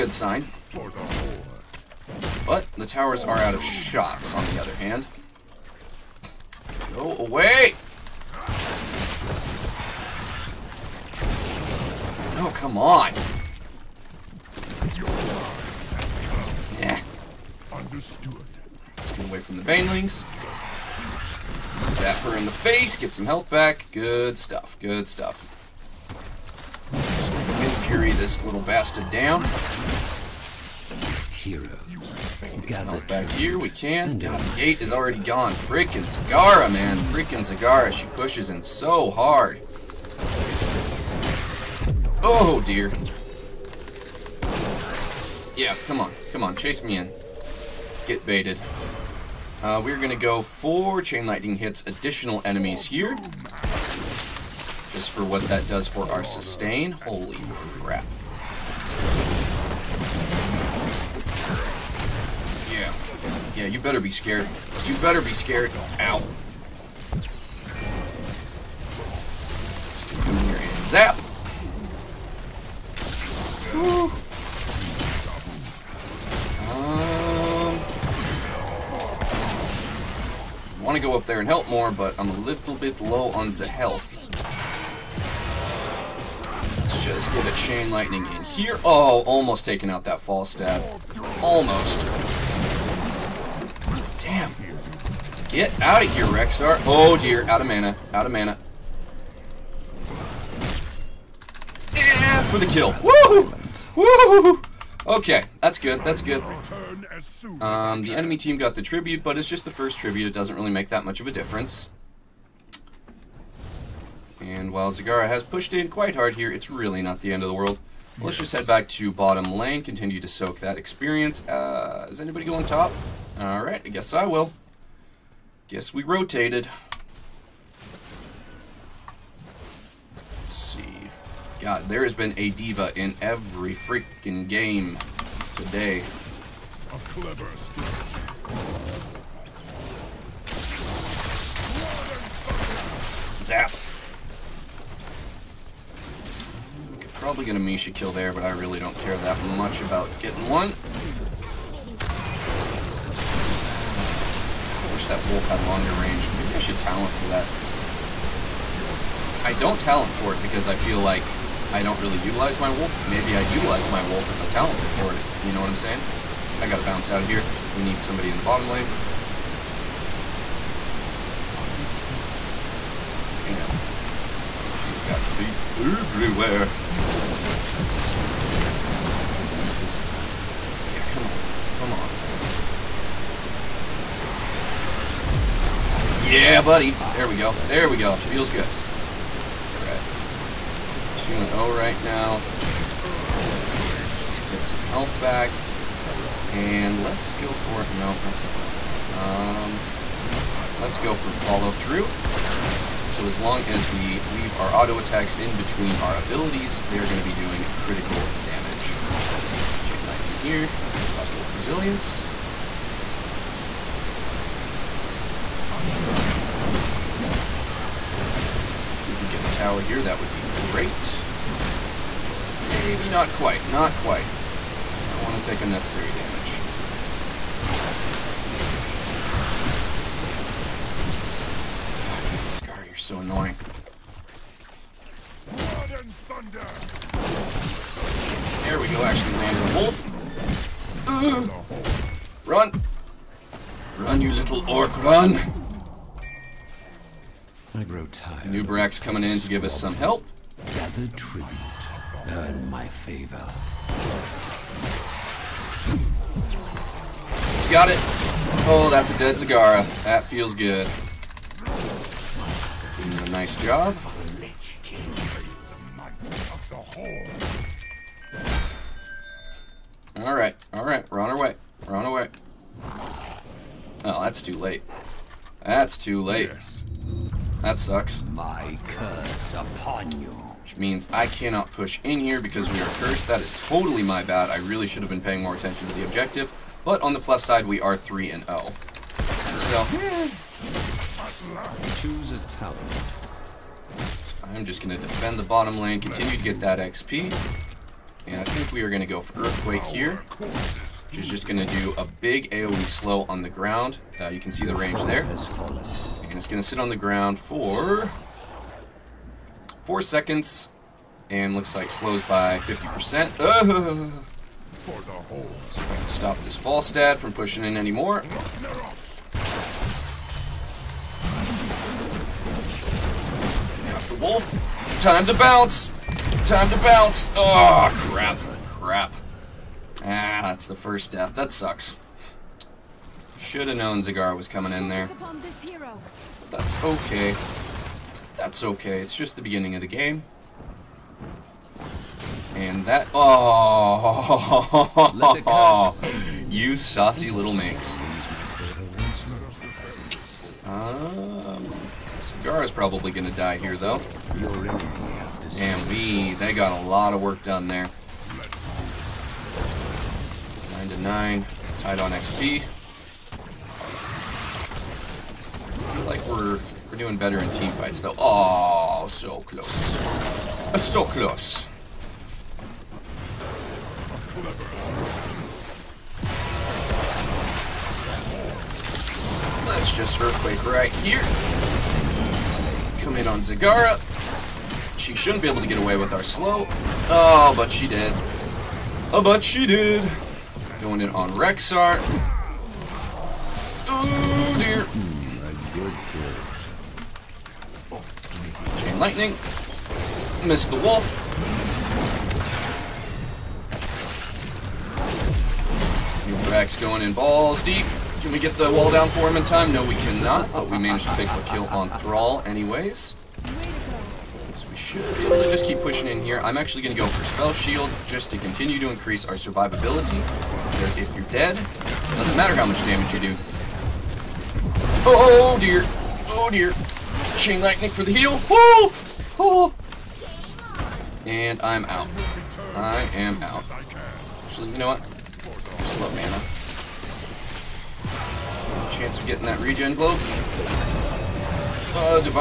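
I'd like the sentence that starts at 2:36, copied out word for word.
Maybe I should talent for that.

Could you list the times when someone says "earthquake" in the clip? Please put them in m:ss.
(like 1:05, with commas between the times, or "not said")
4:59, 6:20.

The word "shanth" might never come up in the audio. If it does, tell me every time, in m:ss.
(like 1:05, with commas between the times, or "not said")
not said.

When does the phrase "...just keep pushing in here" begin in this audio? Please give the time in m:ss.
6:55.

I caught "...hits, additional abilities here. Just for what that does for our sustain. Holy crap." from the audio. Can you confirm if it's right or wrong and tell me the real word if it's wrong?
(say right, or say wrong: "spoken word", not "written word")
wrong: "enemies", not "abilities".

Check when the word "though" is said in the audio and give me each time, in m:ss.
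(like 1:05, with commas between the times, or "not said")
5:53, 6:07.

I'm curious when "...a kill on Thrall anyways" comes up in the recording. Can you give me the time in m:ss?
6:51.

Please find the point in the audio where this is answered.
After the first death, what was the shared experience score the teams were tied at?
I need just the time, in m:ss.
6:00.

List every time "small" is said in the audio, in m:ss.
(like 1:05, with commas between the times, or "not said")
not said.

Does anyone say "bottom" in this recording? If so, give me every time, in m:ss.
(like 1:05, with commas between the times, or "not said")
1:59, 2:48, 4:55.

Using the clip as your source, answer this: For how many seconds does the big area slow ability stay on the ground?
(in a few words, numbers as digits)
4.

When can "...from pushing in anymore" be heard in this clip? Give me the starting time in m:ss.
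5:17.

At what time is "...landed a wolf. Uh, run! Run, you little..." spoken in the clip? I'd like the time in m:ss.
3:59.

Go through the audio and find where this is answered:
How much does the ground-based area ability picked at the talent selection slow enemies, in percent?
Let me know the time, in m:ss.
5:12.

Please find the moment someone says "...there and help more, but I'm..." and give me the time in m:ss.
1:21.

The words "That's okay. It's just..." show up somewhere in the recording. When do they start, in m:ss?
5:38.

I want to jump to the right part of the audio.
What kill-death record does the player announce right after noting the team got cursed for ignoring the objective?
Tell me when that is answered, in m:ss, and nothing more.
4:47.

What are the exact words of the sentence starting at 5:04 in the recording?
Uh, you can see the range there.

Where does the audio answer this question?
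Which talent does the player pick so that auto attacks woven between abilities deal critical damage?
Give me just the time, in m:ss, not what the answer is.
3:21.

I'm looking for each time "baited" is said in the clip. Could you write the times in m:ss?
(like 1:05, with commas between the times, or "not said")
0:48.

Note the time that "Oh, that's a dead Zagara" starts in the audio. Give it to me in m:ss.
4:18.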